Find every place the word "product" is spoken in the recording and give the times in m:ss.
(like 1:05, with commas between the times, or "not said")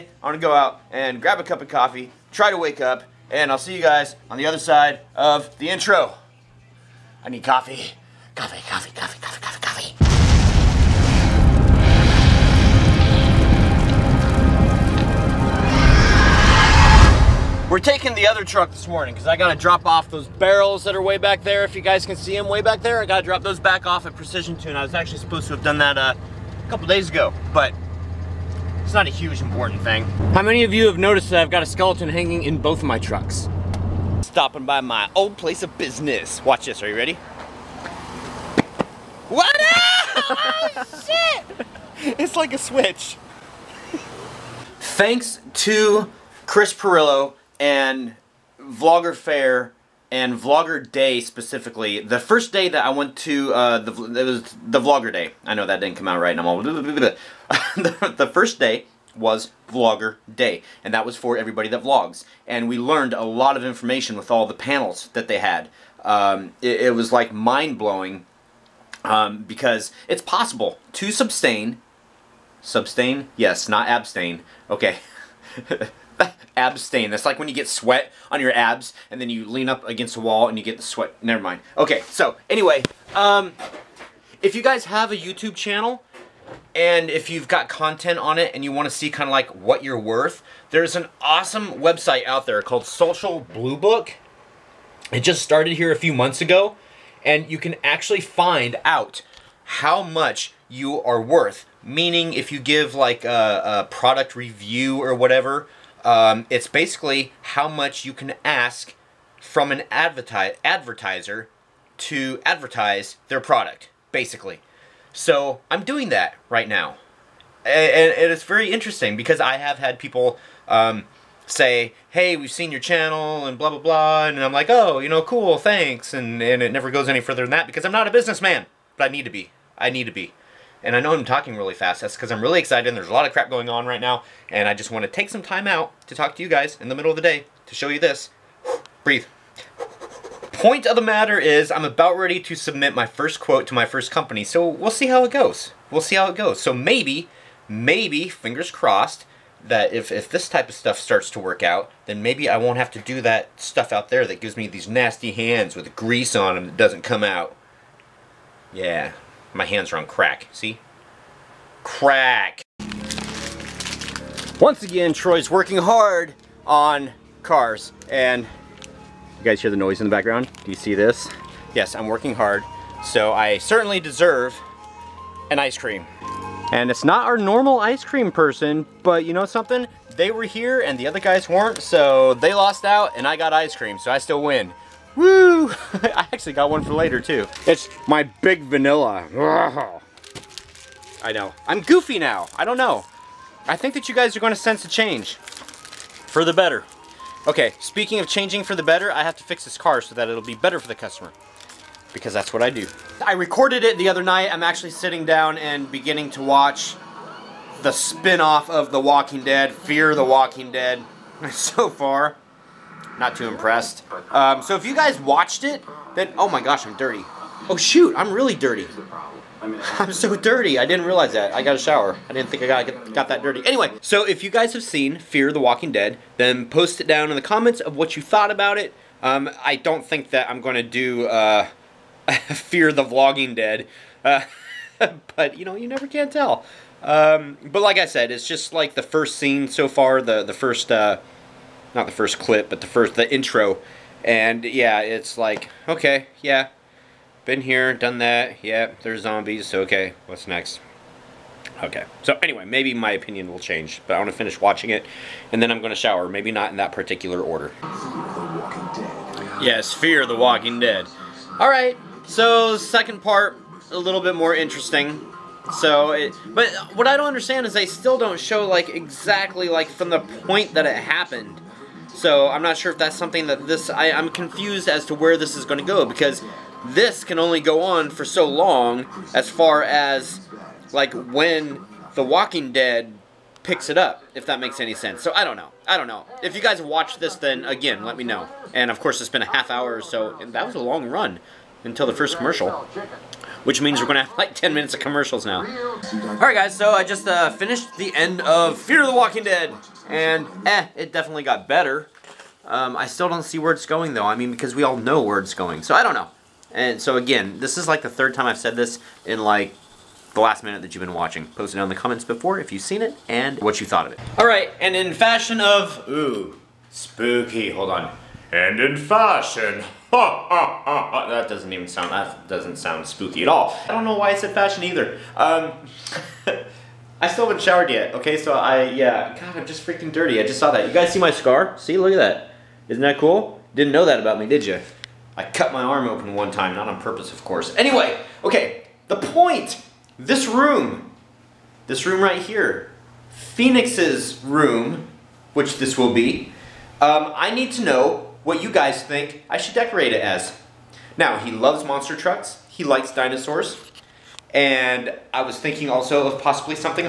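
1:43, 1:53.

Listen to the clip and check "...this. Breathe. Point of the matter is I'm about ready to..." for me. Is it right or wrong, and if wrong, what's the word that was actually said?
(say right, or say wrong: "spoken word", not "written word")
right.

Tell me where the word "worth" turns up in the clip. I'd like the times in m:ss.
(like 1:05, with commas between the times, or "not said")
1:29, 1:41.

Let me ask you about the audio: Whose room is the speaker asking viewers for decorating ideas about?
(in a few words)
Phoenix.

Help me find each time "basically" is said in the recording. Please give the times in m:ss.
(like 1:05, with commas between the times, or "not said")
1:46, 1:54.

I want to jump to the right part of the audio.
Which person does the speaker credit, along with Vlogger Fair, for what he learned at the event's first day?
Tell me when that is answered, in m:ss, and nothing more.
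0:46.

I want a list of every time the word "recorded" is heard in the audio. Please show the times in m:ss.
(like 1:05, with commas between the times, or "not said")
3:23.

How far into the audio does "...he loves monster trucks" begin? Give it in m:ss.
5:51.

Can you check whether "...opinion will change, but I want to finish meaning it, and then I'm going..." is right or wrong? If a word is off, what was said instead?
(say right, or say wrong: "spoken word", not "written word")
wrong: "watching", not "meaning".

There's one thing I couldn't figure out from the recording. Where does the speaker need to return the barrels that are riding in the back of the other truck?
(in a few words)
Precision Tune.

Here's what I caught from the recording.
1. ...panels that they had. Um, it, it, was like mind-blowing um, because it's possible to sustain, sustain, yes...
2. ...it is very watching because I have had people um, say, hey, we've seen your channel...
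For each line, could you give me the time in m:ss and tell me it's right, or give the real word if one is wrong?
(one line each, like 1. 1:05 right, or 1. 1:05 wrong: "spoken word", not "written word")
1. 1:04 right
2. 1:58 wrong: "interesting", not "watching".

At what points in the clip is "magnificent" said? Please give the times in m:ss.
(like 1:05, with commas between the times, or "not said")
not said.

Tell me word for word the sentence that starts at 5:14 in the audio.
All right, and in fashion of, ooh, spooky, hold on.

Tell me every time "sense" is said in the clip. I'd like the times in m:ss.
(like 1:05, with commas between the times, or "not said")
3:14, 4:44.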